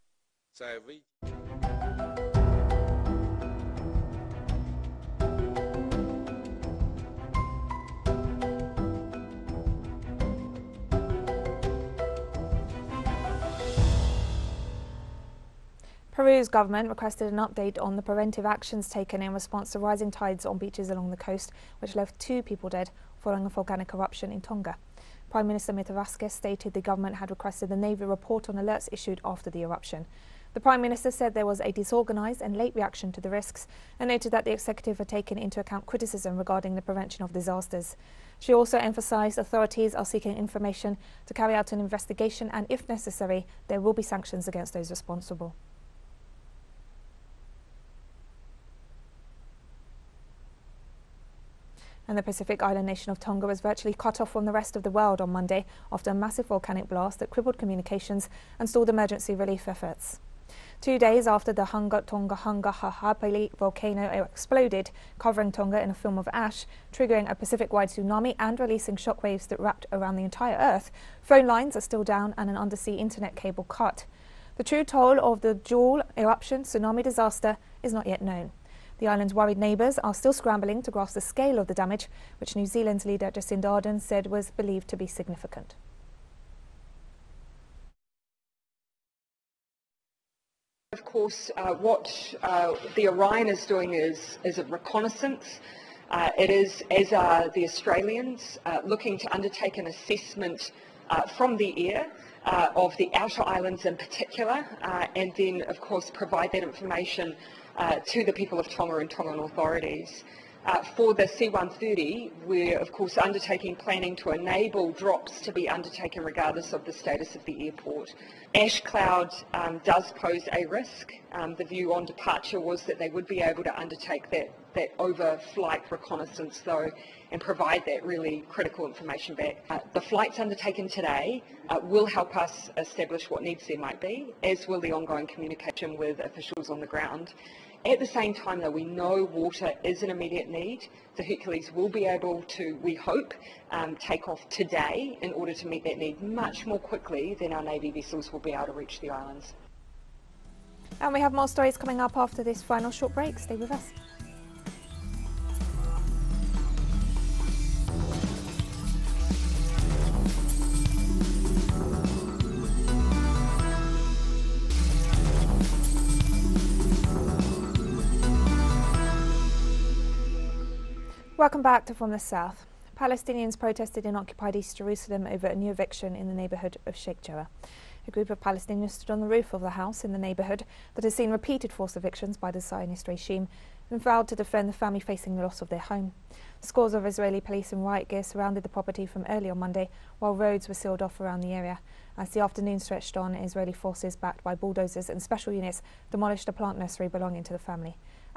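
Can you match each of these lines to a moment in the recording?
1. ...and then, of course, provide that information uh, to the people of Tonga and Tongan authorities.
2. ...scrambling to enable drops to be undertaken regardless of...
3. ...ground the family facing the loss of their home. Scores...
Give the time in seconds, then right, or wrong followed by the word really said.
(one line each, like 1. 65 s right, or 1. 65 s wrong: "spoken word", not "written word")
1. 105 s right
2. 113 s wrong: "planning", not "scrambling"
3. 184 s wrong: "defend", not "ground".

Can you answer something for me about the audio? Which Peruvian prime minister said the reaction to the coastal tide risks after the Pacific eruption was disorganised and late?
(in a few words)
Mirtha Vasquez.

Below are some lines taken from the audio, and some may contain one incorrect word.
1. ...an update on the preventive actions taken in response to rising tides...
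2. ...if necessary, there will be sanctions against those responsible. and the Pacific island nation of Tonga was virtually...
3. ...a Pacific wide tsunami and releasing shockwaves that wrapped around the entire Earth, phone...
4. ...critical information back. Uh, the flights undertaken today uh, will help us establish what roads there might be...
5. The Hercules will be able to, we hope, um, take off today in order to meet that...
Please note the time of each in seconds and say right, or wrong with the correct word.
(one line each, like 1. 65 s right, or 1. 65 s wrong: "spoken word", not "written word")
1. 17 s right
2. 42 s right
3. 67 s right
4. 128 s wrong: "needs", not "roads"
5. 141 s right.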